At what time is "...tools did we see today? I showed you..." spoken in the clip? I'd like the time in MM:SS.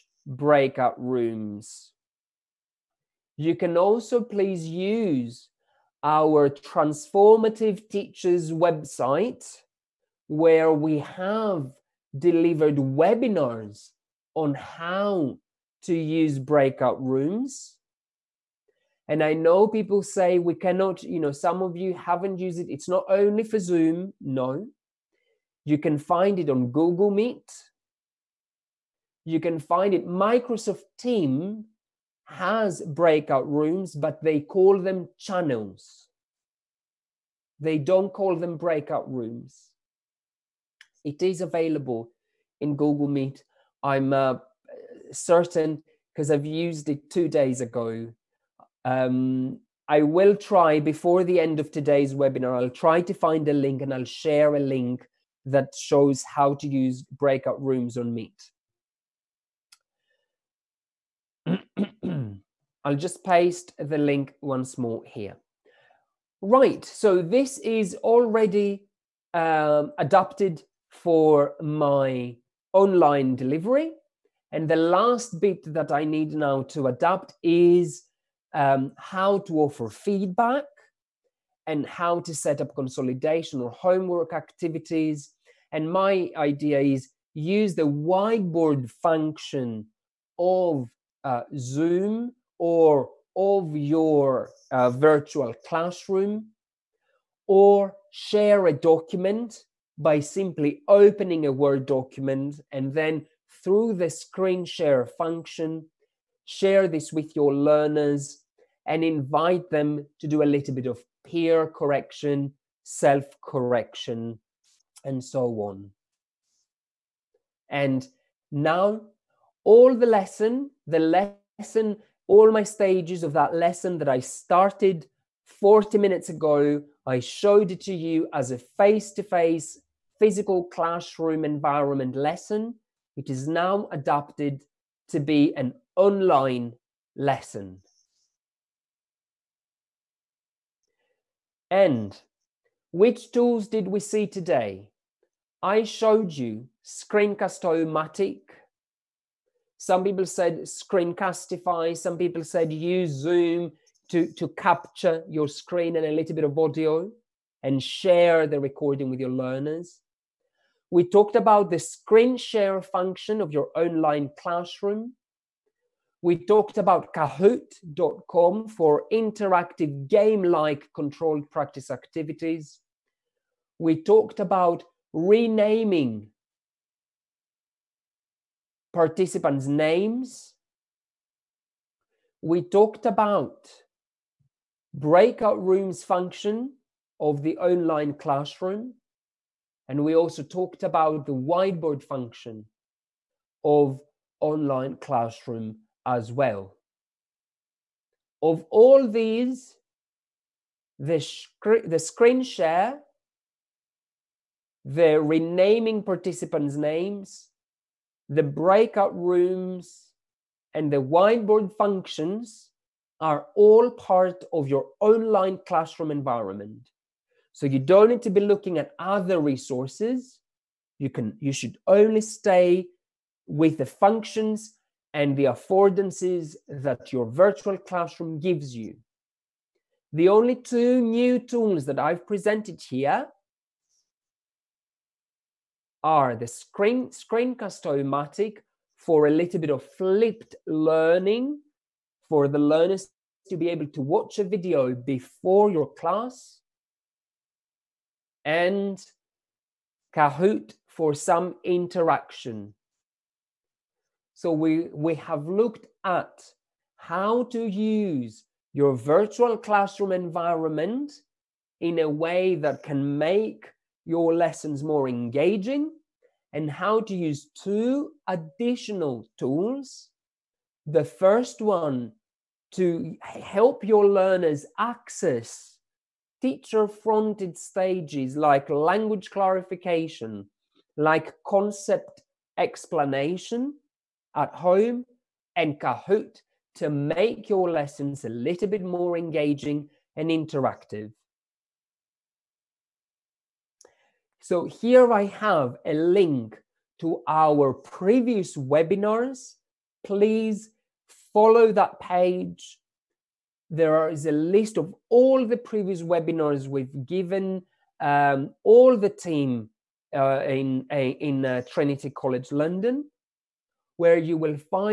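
02:23.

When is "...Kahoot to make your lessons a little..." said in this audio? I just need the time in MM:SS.
04:45.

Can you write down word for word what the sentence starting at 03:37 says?
So you don't need to be looking at other resources.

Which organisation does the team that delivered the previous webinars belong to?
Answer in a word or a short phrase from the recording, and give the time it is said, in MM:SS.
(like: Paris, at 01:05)
Trinity College London, at 05:11.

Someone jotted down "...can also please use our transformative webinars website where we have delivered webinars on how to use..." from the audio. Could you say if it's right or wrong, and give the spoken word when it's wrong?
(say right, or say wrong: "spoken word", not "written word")
wrong: "teachers", not "webinars".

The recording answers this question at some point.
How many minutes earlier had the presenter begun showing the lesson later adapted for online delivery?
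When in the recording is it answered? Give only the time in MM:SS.
02:05.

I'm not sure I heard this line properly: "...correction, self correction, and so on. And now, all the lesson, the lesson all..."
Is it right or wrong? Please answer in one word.
right.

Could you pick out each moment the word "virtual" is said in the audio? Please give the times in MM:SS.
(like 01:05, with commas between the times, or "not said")
01:34, 03:47, 04:18.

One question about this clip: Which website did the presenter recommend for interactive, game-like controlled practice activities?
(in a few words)
Kahoot.com.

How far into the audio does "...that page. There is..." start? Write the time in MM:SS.
05:01.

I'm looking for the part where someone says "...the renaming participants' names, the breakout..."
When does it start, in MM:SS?
03:24.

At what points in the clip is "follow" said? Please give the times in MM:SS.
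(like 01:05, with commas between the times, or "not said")
05:01.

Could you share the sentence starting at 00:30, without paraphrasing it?
Microsoft Team has breakout rooms, but they call them channels.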